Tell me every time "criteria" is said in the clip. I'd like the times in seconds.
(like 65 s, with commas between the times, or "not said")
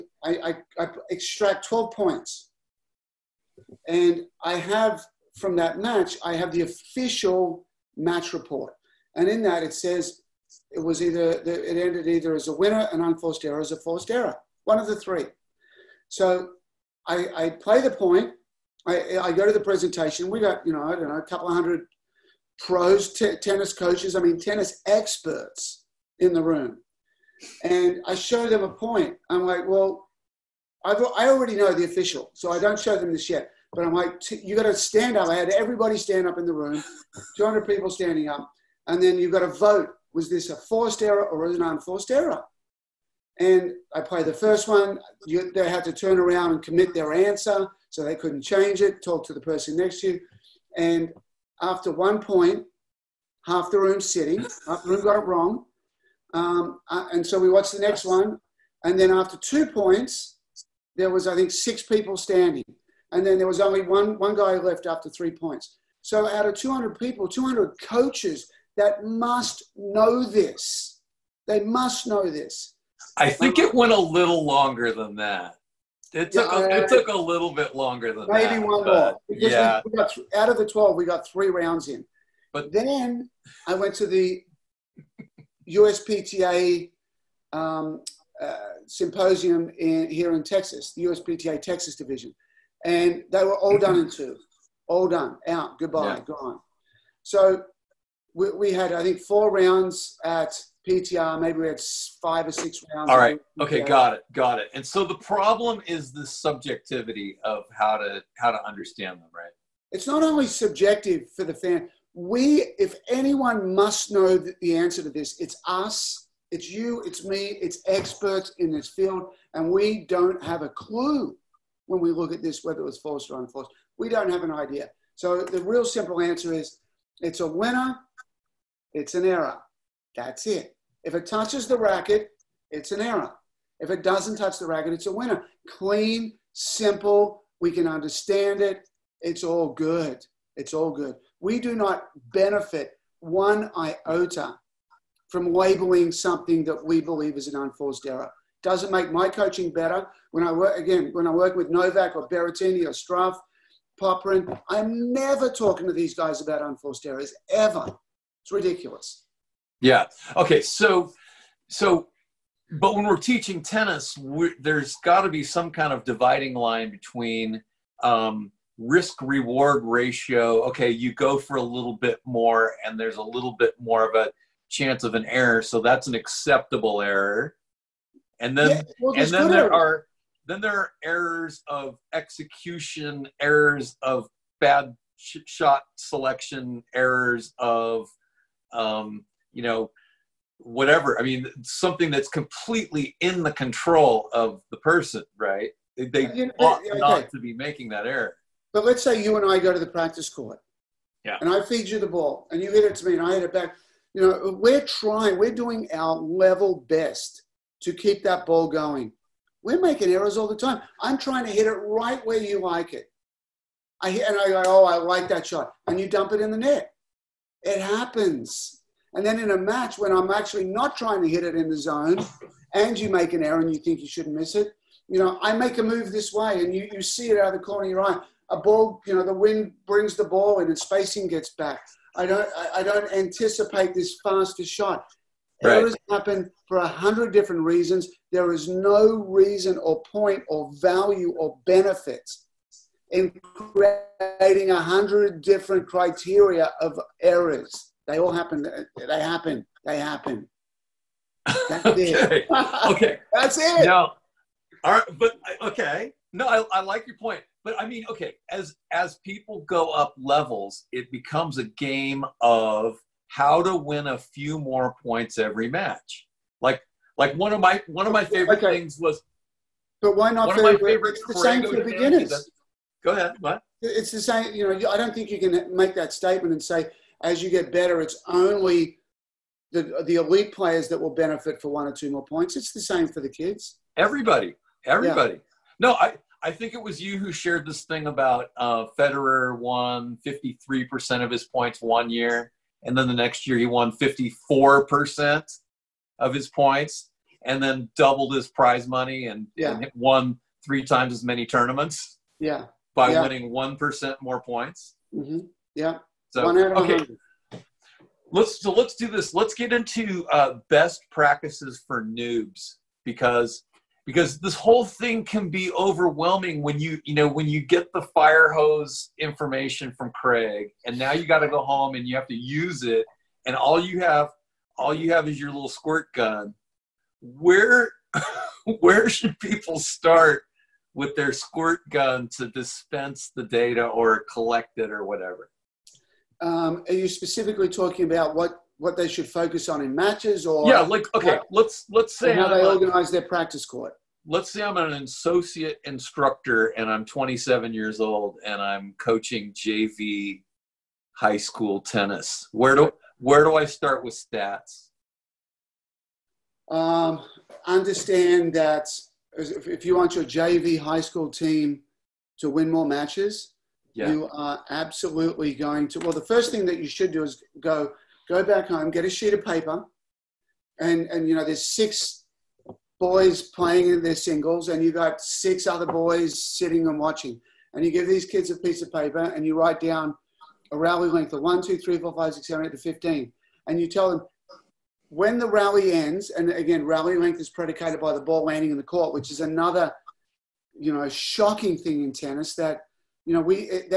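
245 s.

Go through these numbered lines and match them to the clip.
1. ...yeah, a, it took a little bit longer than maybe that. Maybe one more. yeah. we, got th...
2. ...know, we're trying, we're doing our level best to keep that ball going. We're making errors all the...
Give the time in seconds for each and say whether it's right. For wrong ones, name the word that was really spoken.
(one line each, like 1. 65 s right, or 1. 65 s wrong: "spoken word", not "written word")
1. 76 s right
2. 204 s right.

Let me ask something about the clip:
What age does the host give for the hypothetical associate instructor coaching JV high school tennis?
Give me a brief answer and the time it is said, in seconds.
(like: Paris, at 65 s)
27, at 347 s.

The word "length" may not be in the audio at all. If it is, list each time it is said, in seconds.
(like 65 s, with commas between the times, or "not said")
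381 s, 387 s.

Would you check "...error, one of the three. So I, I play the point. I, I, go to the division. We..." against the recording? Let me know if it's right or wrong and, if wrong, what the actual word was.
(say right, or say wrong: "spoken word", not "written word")
wrong: "presentation", not "division".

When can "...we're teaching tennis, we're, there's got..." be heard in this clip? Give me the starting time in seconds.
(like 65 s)
163 s.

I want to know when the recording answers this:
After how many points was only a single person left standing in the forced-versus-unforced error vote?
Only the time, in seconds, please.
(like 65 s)
65 s.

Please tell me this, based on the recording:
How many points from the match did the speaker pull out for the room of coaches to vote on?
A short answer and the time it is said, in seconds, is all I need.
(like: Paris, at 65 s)
12, at 1 s.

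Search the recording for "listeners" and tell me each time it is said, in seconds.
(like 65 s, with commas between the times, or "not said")
not said.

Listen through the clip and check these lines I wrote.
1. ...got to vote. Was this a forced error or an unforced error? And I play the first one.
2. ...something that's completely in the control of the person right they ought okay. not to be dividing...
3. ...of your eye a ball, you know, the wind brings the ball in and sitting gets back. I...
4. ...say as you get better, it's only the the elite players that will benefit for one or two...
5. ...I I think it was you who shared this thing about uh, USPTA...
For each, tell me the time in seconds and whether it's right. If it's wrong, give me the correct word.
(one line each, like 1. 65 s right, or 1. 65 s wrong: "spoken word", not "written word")
1. 39 s right
2. 191 s wrong: "making", not "dividing"
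3. 227 s wrong: "spacing", not "sitting"
4. 276 s right
5. 285 s wrong: "Federer", not "USPTA".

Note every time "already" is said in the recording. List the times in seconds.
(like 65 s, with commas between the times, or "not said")
31 s.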